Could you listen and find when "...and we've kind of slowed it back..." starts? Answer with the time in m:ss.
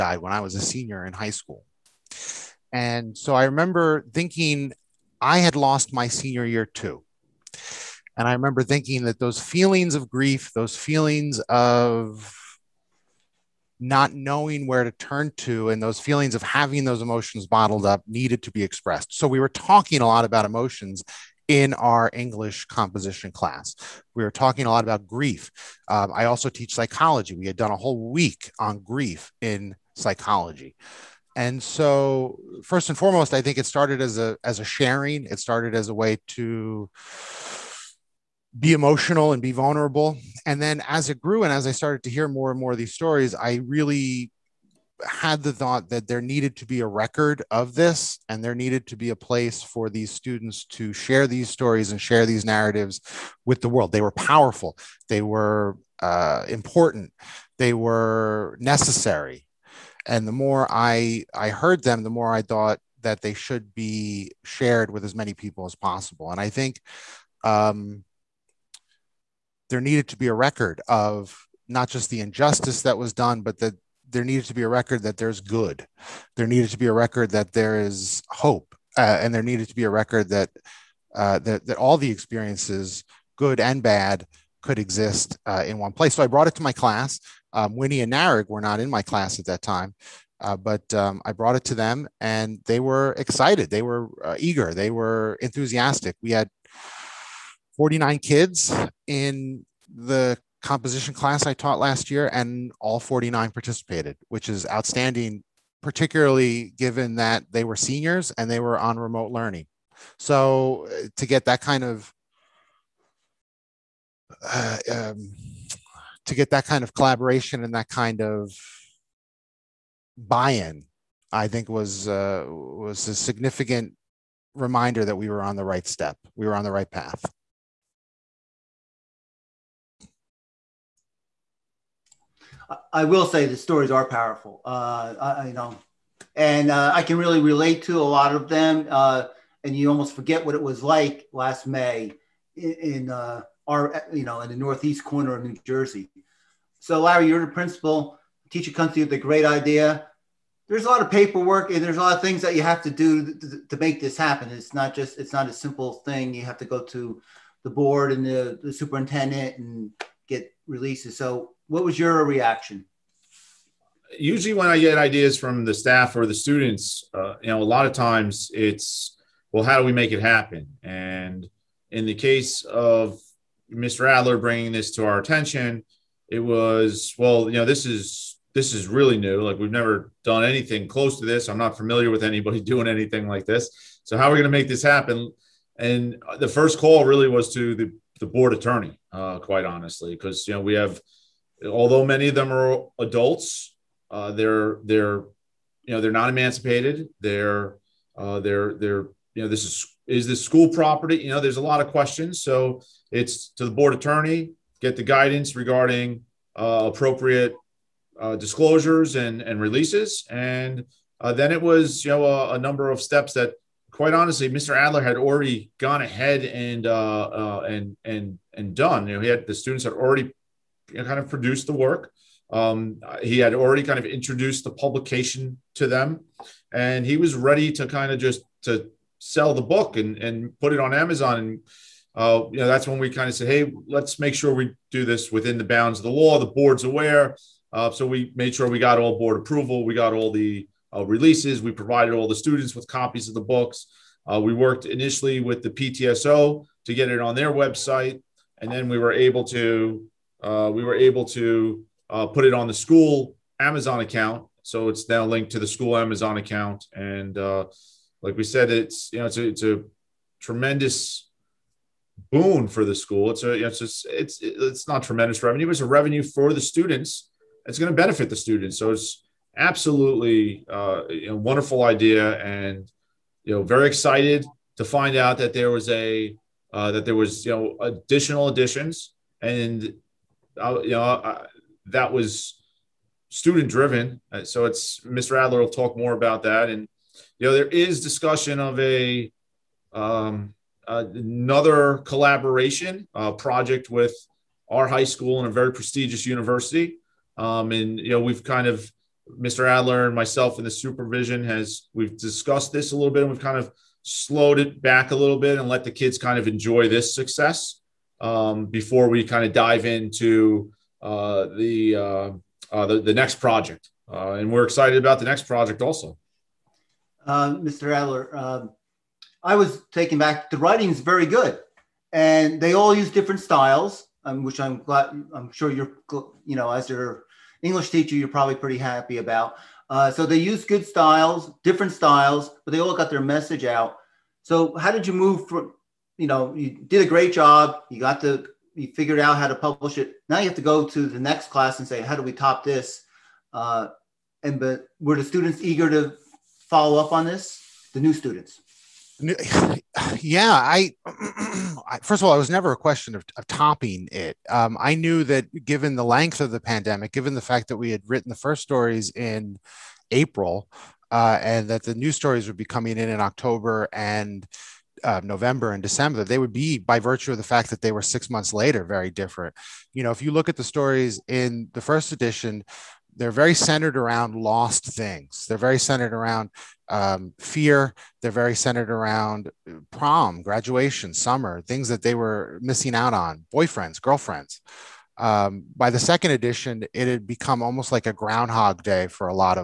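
5:03.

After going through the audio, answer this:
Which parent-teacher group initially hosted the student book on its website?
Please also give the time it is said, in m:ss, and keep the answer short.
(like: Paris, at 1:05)
PTSO, at 4:05.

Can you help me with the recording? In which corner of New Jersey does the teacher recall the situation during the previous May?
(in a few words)
northeast.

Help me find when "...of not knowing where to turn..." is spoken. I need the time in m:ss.
0:11.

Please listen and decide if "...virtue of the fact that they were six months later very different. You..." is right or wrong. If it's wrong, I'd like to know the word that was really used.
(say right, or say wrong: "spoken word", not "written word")
right.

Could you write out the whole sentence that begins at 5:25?
I'm sure you're, you know, as your English teacher, you're probably pretty happy about.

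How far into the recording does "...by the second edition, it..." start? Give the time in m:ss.
6:25.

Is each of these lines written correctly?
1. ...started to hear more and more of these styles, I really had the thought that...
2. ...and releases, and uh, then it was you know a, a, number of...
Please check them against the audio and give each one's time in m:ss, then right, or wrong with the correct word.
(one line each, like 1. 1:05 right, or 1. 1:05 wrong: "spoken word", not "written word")
1. 0:41 wrong: "stories", not "styles"
2. 3:29 right.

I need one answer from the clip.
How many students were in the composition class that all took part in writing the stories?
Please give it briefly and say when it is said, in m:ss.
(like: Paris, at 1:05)
49, at 1:37.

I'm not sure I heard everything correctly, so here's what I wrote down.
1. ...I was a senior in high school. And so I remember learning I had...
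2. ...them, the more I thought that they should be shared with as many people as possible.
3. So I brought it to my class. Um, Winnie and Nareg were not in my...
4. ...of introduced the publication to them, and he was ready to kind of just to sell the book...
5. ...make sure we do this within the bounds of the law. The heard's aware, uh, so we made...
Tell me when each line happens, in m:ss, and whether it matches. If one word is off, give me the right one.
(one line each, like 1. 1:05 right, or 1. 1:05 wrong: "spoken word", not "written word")
1. 0:00 wrong: "thinking", not "learning"
2. 1:01 right
3. 1:26 right
4. 3:43 right
5. 3:54 wrong: "board", not "heard".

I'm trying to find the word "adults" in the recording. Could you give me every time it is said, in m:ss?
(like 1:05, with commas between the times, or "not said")
3:12.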